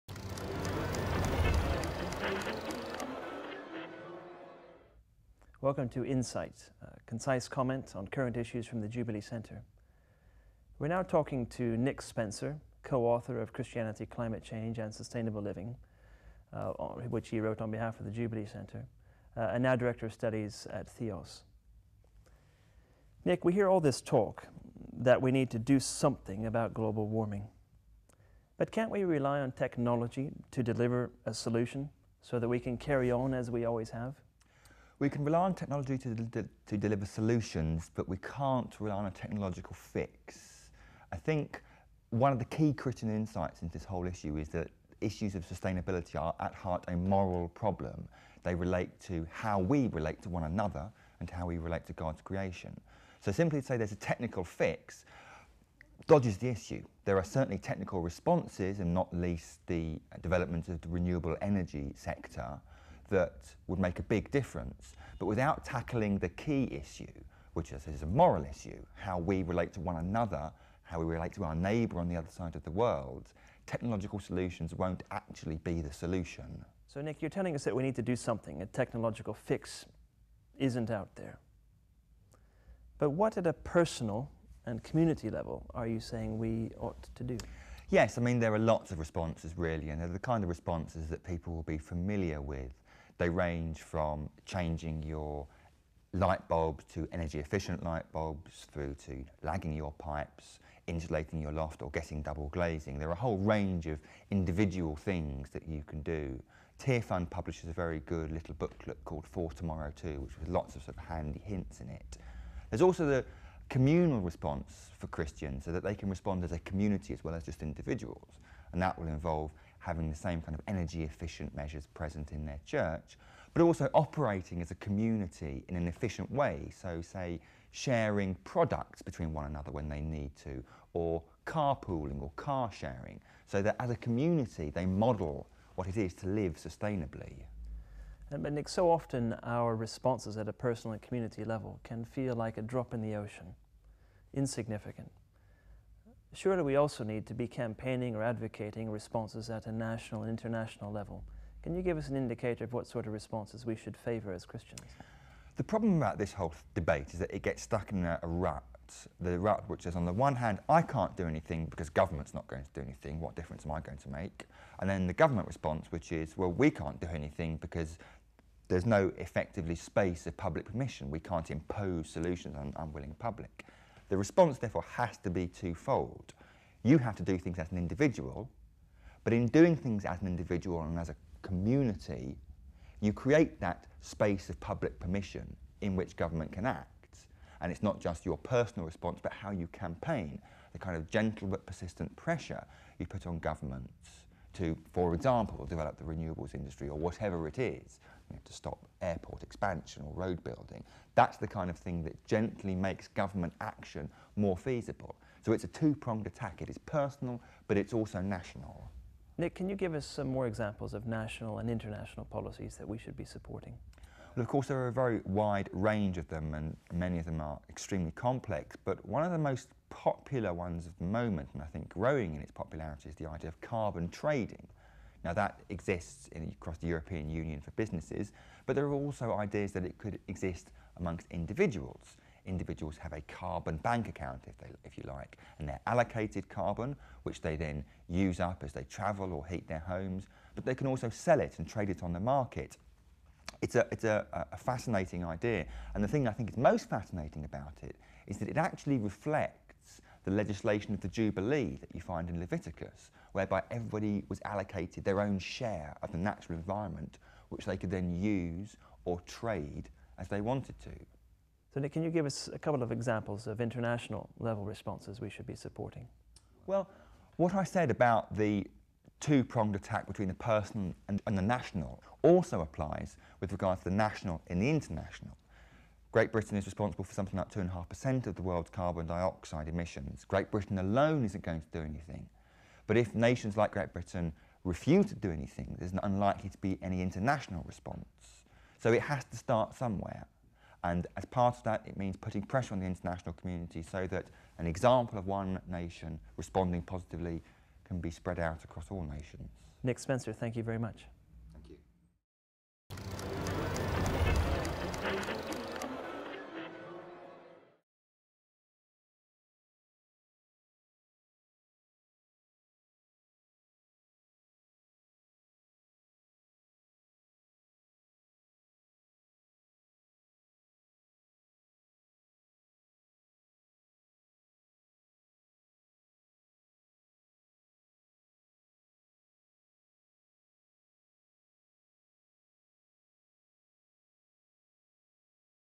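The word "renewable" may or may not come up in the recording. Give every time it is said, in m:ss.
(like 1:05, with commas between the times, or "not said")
1:00, 3:16.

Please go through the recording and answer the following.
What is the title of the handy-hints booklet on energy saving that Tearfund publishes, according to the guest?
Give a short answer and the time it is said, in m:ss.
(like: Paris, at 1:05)
For Tomorrow Too, at 1:49.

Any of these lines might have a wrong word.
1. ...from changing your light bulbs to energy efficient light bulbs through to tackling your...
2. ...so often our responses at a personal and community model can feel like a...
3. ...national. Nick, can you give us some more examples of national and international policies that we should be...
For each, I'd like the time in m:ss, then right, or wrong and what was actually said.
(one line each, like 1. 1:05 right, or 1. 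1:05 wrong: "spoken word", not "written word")
1. 1:33 wrong: "lagging", not "tackling"
2. 2:18 wrong: "level", not "model"
3. 3:28 right.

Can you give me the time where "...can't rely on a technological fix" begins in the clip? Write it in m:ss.
0:38.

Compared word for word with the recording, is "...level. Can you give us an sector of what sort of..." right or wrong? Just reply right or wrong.
wrong.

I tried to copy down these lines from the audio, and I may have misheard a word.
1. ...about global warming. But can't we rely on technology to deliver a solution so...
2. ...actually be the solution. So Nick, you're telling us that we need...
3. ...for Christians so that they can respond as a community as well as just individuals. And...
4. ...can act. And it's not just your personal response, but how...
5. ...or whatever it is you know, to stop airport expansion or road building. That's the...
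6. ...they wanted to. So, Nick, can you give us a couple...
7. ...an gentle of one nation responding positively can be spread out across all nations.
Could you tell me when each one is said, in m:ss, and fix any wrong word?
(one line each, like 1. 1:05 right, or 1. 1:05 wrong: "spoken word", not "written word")
1. 0:26 right
2. 1:15 right
3. 1:54 right
4. 3:06 right
5. 3:16 right
6. 4:20 right
7. 4:54 wrong: "example", not "gentle".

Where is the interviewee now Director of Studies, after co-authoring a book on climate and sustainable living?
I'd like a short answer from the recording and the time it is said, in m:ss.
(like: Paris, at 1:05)
Theos, at 0:20.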